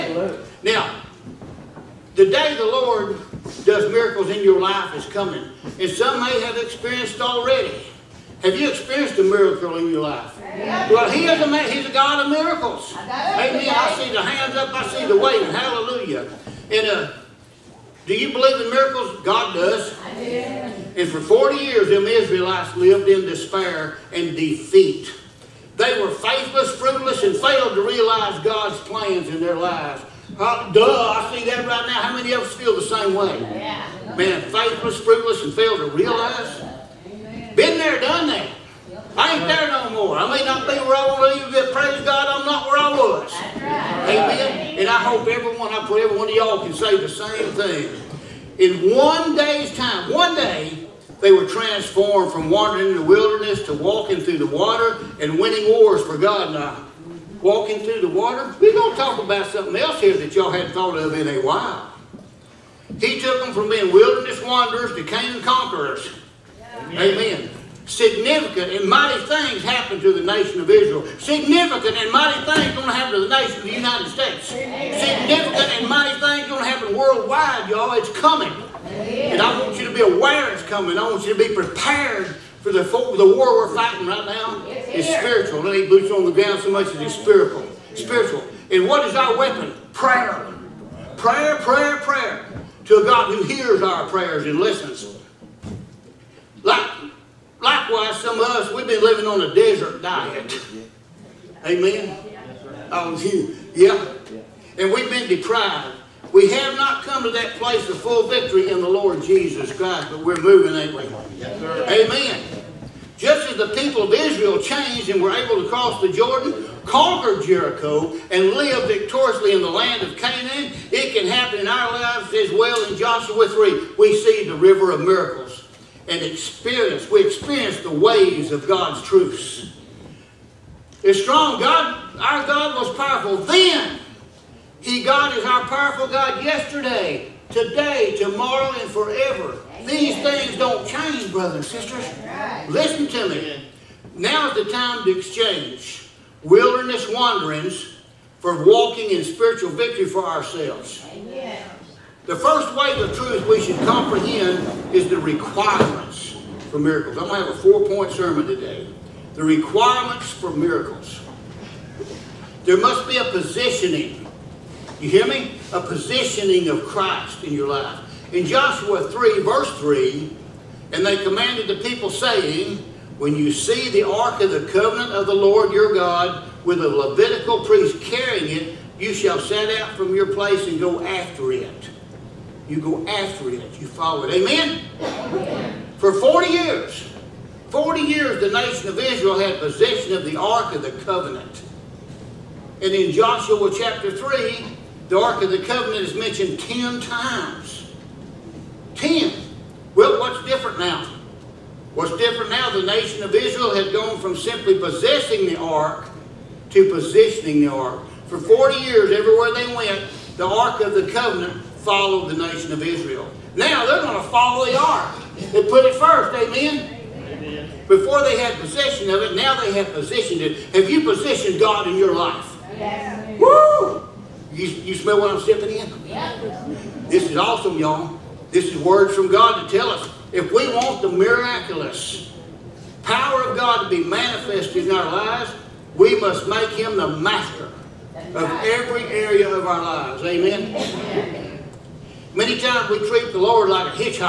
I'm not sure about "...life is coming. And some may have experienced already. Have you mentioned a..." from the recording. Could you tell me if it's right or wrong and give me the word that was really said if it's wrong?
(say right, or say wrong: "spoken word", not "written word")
wrong: "experienced", not "mentioned".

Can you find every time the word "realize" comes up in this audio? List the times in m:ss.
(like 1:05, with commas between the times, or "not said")
0:27, 0:35.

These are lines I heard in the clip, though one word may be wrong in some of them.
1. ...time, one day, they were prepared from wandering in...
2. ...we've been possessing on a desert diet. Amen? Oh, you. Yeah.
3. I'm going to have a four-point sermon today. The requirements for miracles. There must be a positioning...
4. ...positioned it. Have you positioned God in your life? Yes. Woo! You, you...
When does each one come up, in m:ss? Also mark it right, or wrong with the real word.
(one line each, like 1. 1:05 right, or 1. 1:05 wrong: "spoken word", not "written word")
1. 0:49 wrong: "transformed", not "prepared"
2. 1:38 wrong: "living", not "possessing"
3. 2:37 right
4. 3:39 right.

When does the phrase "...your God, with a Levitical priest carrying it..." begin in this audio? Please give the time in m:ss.
2:55.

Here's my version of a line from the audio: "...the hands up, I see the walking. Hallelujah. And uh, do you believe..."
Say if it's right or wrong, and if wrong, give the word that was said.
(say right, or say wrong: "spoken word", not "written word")
wrong: "waving", not "walking".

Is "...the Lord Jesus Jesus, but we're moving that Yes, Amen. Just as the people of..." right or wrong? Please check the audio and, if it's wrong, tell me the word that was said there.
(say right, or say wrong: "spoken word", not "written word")
wrong: "Christ", not "Jesus".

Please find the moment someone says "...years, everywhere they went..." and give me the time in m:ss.
3:28.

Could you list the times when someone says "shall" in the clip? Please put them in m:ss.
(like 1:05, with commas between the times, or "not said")
2:59.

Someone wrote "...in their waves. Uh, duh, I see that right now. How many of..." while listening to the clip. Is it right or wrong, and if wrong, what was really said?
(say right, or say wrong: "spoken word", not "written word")
wrong: "lives", not "waves".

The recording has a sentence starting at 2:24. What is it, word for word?
Now is the time to exchange wilderness wanderings for walking in spiritual victory for ourselves.